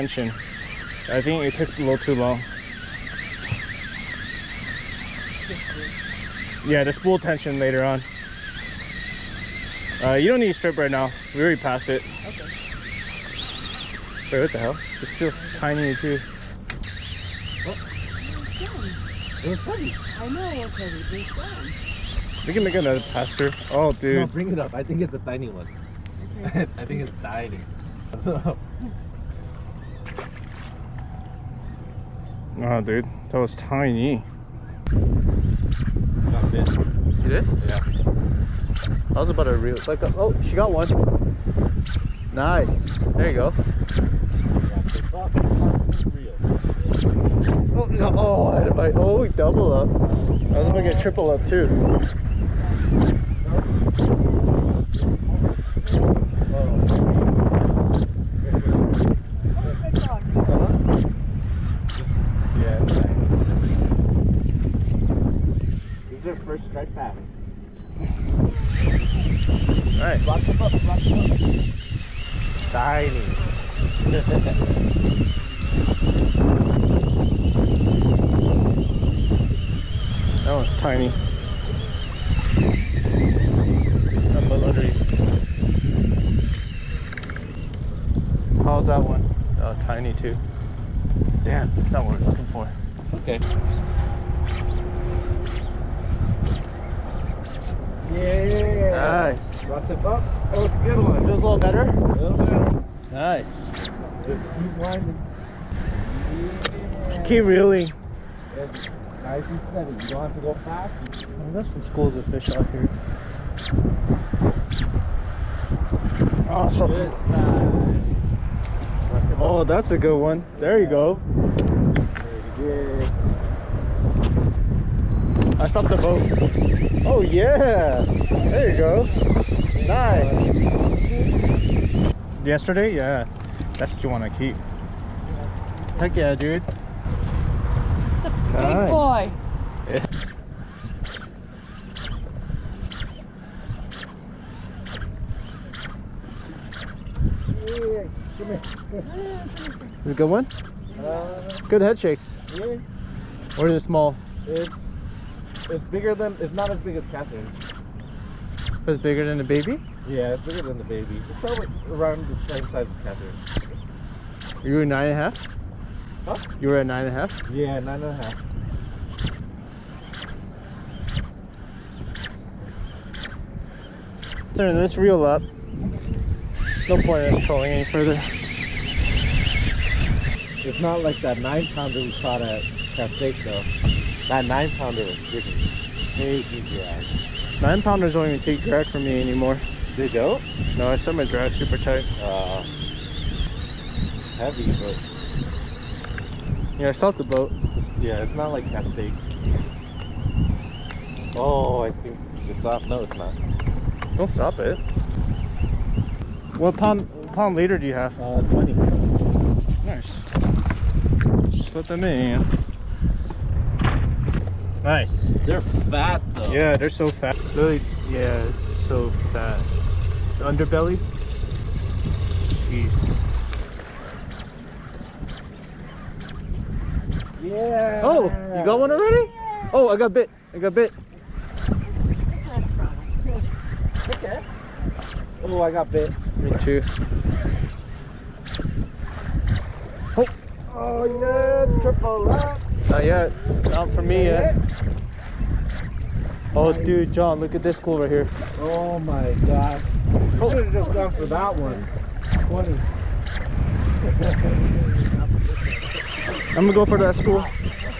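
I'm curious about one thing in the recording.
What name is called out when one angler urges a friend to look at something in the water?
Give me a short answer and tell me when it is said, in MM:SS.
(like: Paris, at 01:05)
John, at 04:07.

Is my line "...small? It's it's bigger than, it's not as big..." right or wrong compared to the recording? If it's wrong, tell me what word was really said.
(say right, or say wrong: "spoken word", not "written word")
right.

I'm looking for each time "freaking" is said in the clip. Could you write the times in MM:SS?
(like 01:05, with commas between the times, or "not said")
03:05.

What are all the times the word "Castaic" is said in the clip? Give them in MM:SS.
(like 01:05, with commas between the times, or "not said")
03:02, 03:18.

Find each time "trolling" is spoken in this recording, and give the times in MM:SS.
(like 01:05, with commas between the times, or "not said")
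02:57.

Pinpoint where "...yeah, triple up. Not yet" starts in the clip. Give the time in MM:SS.
04:01.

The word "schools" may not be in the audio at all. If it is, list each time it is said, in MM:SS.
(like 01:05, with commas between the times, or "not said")
01:51, 04:17.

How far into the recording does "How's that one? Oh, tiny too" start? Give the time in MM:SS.
01:28.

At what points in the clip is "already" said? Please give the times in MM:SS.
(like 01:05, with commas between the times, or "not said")
00:11, 03:48.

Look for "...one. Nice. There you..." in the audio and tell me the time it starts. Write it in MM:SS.
00:40.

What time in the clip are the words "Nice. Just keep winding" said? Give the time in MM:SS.
01:43.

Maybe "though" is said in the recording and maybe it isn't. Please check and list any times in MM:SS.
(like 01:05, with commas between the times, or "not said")
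03:03, 03:36.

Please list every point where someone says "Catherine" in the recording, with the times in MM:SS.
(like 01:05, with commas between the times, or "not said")
02:37, 02:43.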